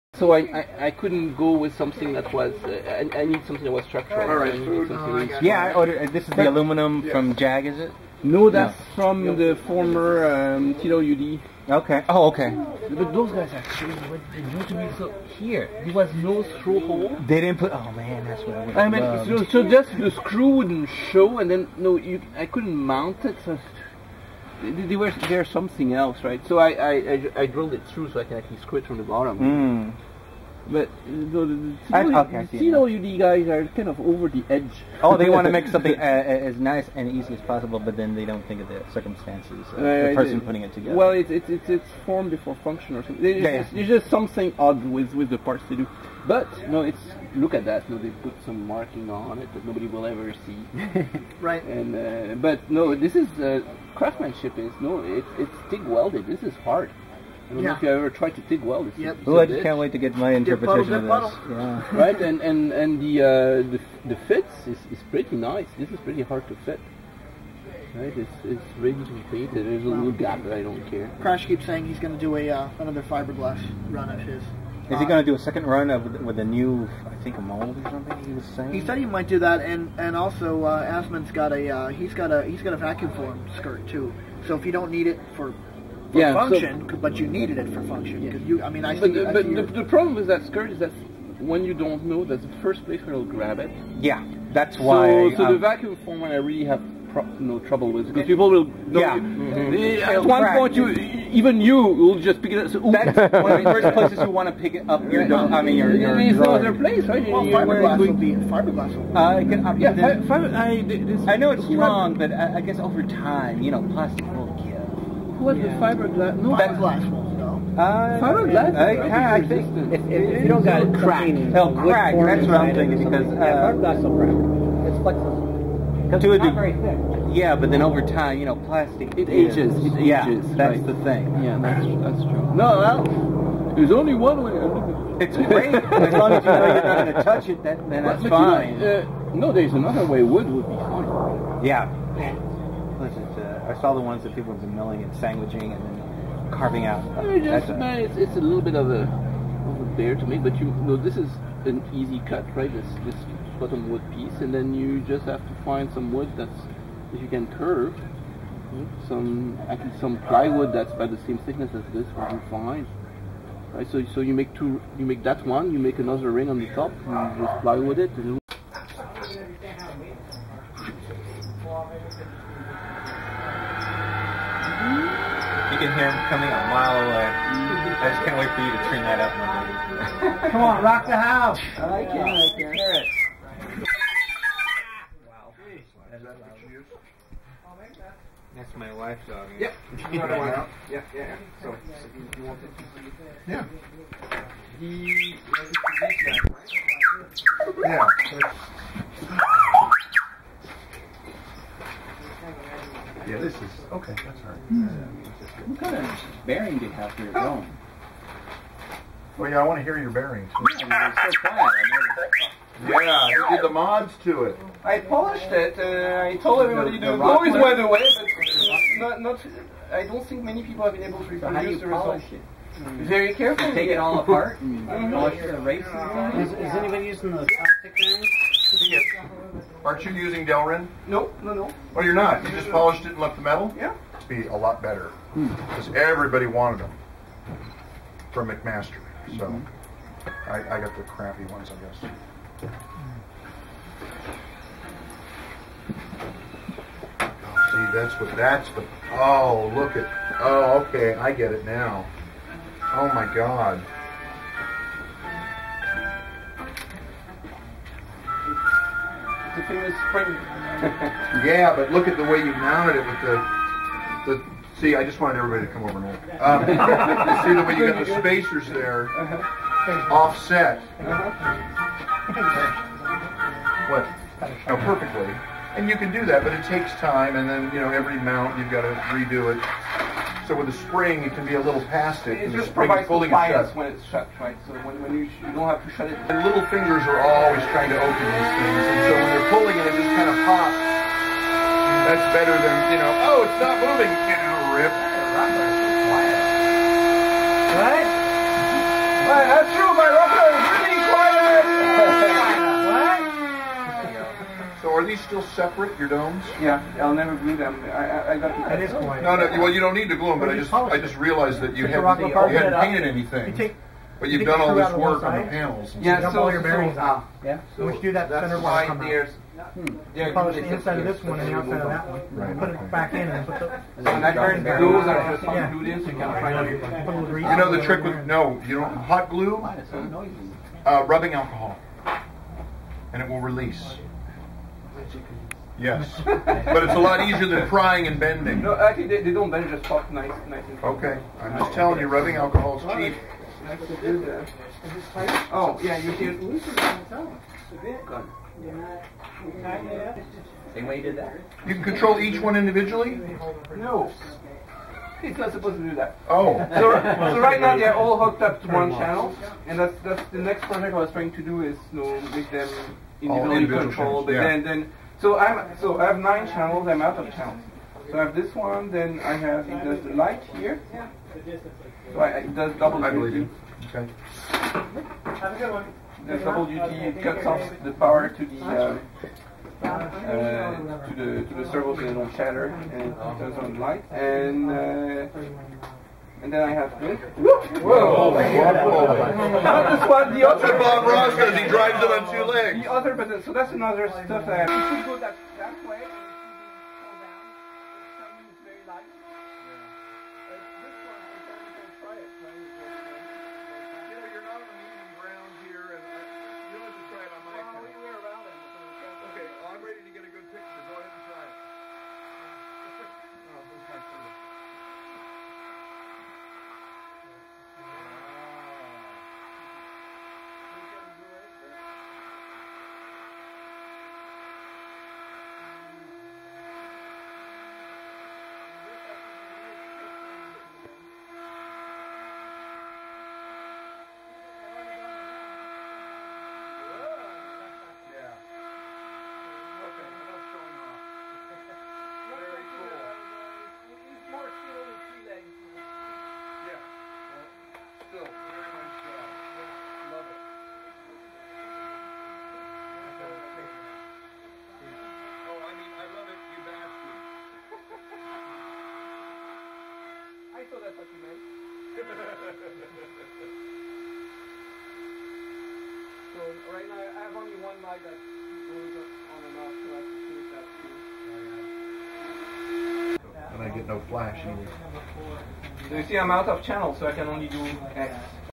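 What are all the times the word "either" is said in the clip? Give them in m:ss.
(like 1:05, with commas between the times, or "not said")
7:54.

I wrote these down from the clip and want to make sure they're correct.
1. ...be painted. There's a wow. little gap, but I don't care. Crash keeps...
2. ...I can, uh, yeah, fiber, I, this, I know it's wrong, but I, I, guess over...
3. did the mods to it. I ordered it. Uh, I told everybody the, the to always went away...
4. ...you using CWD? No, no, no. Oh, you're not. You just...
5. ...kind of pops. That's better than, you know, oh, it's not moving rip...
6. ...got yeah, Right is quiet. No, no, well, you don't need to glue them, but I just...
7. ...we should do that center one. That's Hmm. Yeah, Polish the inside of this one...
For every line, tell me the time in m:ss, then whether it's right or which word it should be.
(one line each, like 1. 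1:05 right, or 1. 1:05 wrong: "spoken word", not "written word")
1. 1:09 right
2. 1:49 right
3. 3:33 wrong: "polished", not "ordered"
4. 3:50 wrong: "Delrin", not "CWD"
5. 4:50 right
6. 5:08 wrong: "That", not "Right"
7. 5:17 right.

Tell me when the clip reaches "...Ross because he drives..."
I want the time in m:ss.
6:31.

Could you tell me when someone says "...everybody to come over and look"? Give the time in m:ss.
4:25.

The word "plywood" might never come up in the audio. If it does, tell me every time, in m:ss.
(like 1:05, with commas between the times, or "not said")
2:40, 2:47.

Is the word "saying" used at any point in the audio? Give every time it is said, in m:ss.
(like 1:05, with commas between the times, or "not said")
1:11, 1:18.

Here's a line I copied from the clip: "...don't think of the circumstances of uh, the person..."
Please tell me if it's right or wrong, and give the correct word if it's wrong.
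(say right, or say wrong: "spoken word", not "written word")
right.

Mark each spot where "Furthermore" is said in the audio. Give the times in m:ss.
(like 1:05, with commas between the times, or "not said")
not said.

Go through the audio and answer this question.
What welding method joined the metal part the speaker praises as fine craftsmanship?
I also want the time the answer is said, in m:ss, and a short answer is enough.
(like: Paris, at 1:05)
TIG welded, at 0:55.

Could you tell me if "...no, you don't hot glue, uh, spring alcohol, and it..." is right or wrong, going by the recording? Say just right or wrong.
wrong.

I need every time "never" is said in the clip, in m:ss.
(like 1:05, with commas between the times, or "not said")
5:07.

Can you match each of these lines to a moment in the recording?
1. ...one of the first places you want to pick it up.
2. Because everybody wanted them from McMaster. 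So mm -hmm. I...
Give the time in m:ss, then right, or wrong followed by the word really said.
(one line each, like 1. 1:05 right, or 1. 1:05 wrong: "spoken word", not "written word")
1. 1:43 right
2. 3:55 right.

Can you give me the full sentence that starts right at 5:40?
And okay, I'm just telling you, rubbing alcohol is cheap.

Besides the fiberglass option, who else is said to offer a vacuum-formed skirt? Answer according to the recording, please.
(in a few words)
Asman.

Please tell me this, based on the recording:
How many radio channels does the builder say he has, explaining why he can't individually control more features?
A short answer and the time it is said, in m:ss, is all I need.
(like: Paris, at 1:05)
9, at 6:06.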